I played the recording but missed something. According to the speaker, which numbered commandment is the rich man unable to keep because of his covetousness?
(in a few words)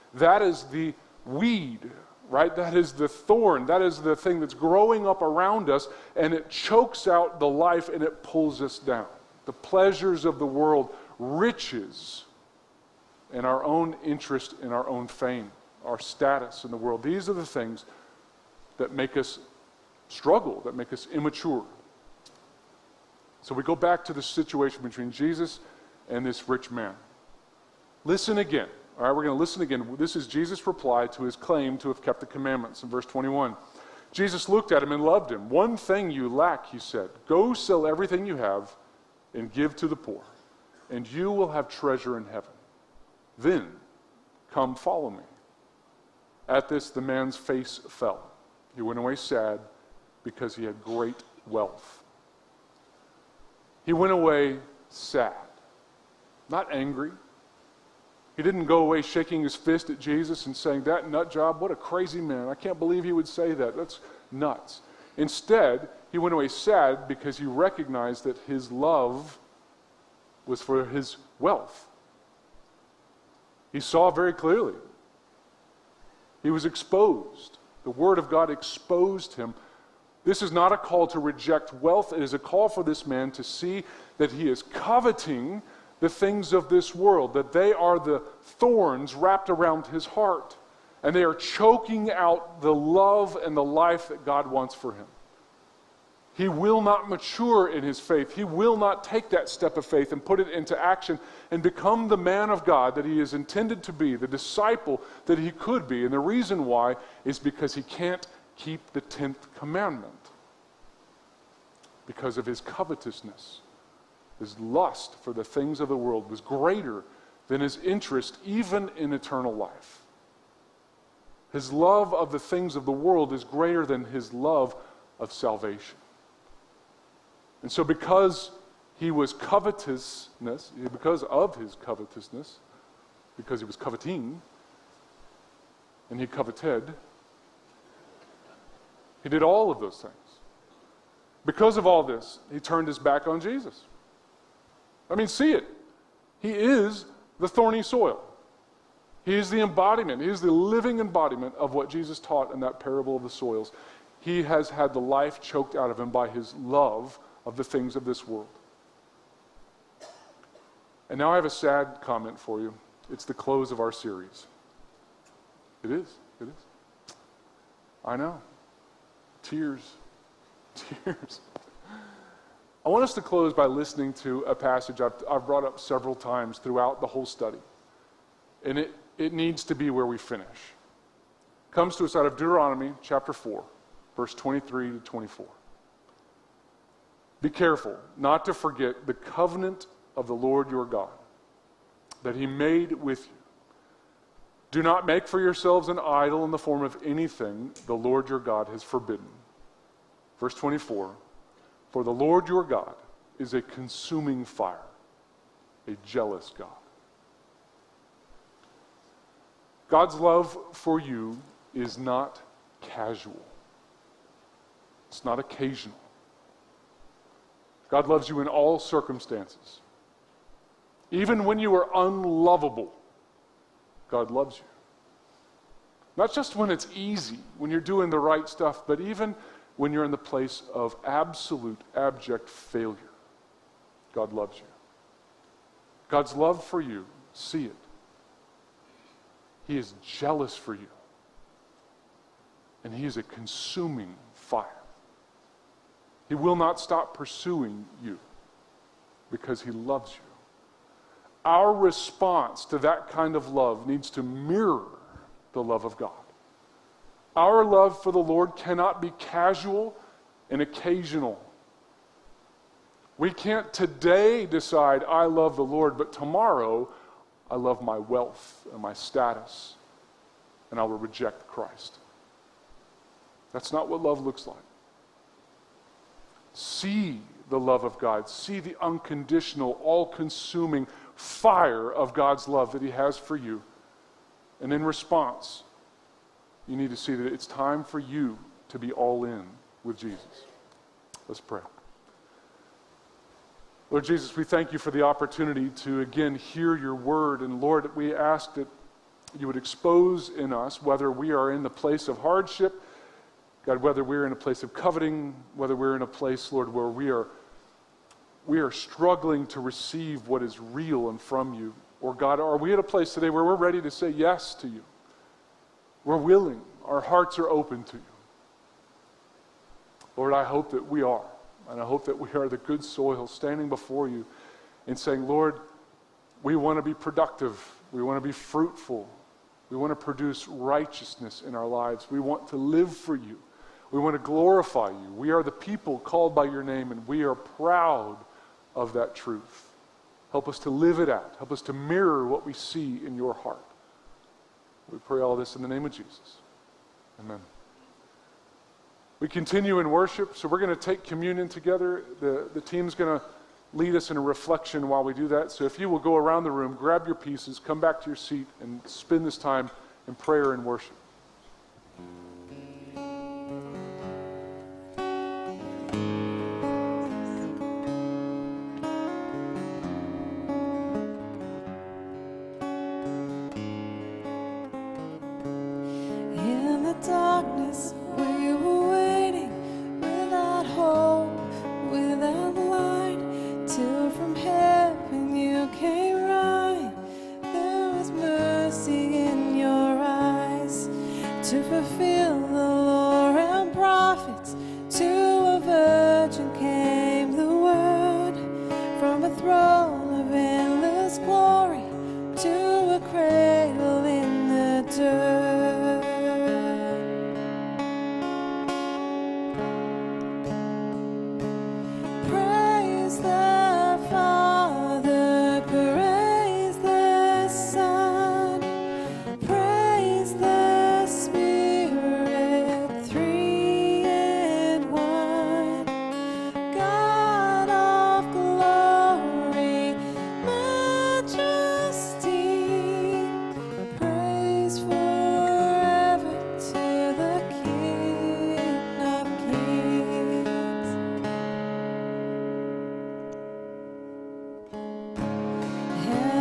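10th.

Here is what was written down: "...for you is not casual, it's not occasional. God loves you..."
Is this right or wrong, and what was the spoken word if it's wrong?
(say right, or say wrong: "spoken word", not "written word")
right.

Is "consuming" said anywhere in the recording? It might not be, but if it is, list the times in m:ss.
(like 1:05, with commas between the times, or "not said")
3:23, 4:03, 4:40.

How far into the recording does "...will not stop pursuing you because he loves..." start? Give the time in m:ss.
4:06.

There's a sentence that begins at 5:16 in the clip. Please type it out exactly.
We're willing, our hearts are open to you.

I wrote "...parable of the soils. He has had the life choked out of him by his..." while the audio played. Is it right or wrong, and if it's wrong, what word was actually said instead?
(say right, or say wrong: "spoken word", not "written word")
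right.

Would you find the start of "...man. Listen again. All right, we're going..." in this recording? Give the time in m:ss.
0:26.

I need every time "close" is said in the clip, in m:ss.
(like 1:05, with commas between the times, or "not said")
2:43, 2:53.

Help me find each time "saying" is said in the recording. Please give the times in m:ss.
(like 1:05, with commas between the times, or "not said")
1:00, 5:24.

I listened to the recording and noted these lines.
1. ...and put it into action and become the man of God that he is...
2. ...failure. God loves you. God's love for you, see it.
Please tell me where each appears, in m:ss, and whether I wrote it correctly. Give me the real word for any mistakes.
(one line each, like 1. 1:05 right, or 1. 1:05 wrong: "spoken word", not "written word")
1. 1:40 right
2. 3:52 right.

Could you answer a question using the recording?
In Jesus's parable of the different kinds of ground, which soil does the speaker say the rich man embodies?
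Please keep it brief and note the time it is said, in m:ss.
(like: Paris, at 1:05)
thorny soil, at 2:27.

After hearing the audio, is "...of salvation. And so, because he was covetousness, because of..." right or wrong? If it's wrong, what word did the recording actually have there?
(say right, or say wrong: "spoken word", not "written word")
right.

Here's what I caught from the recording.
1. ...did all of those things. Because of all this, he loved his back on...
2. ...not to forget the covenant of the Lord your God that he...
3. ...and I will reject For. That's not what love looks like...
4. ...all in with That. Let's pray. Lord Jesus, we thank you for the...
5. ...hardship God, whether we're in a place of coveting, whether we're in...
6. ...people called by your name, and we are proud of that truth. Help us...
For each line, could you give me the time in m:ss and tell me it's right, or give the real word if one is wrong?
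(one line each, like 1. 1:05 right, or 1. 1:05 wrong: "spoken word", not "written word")
1. 2:19 wrong: "turned", not "loved"
2. 3:08 right
3. 4:30 wrong: "Christ", not "For"
4. 4:48 wrong: "Jesus", not "That"
5. 5:02 right
6. 5:35 right.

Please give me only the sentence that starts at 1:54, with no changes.
His lust for the things of the world was greater than his interest even in eternal life.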